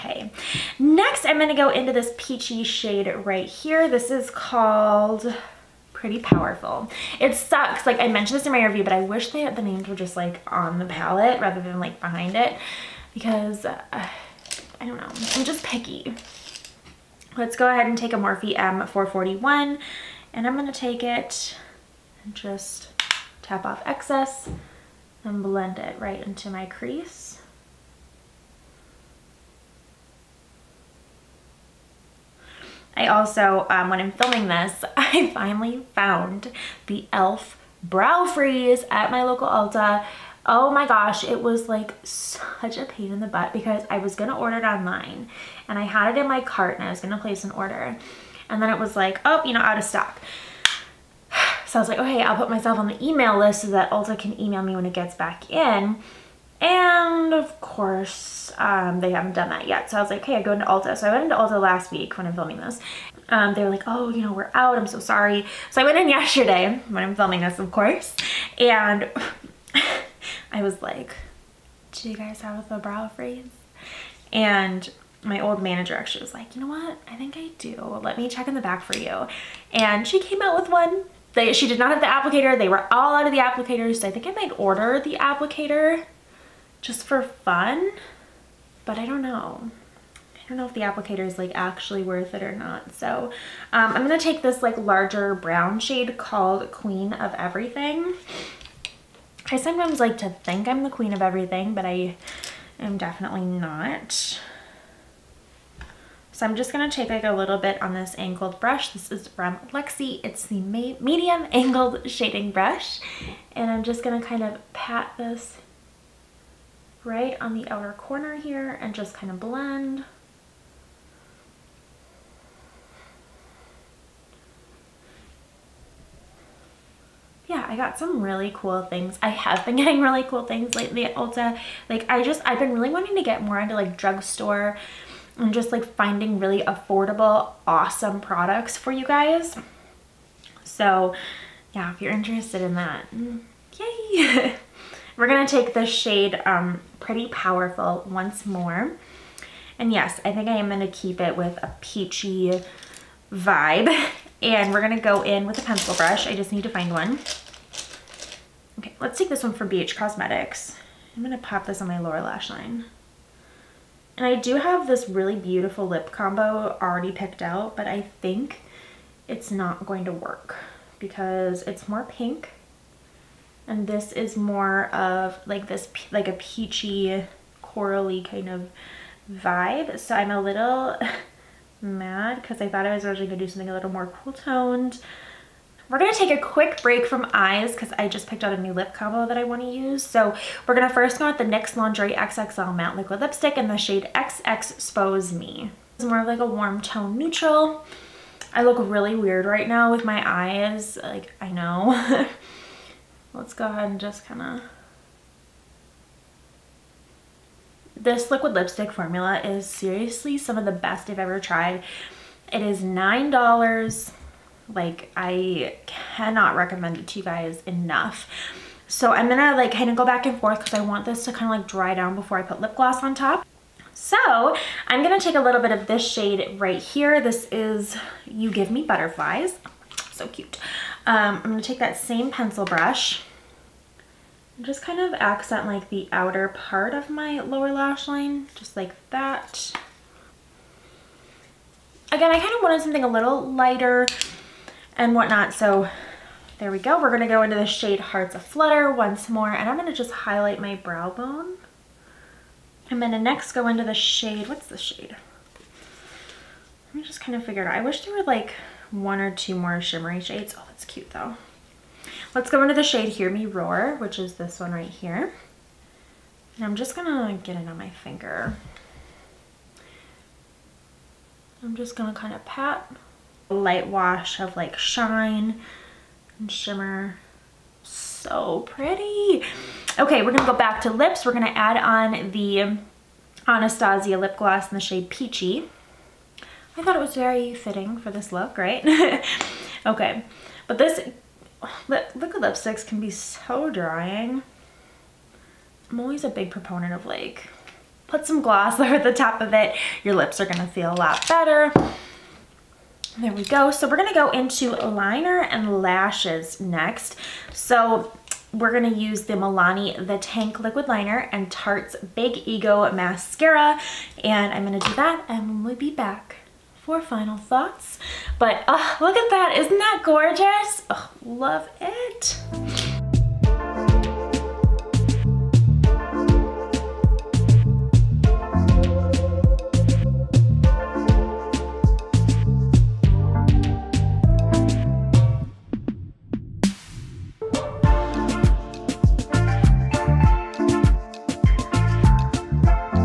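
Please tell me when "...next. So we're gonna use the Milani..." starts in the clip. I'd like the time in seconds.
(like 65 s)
306 s.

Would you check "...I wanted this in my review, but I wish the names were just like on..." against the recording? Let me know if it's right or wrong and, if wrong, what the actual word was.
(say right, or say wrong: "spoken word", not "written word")
wrong: "mentioned", not "wanted".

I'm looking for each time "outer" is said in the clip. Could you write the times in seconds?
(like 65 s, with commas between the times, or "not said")
117 s, 236 s.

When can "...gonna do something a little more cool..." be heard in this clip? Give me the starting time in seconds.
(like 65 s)
183 s.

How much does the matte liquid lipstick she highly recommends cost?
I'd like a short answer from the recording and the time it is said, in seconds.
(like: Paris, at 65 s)
$9, at 212 s.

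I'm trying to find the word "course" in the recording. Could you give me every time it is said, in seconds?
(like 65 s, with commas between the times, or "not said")
57 s, 67 s.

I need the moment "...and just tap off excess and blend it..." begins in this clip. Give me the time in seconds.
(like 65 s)
22 s.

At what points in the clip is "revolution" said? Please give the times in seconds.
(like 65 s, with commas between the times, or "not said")
not said.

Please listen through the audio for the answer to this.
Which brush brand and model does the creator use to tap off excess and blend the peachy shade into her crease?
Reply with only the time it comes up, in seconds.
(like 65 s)
18 s.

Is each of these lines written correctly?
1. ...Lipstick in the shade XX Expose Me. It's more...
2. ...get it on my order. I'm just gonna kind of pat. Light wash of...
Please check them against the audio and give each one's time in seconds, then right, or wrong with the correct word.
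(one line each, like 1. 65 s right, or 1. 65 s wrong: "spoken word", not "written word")
1. 193 s right
2. 267 s wrong: "finger", not "order".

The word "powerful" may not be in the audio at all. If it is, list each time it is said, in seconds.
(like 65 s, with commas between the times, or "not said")
6 s, 147 s.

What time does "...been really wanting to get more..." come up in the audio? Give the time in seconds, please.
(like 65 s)
132 s.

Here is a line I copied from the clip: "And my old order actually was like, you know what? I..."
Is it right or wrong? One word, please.
wrong.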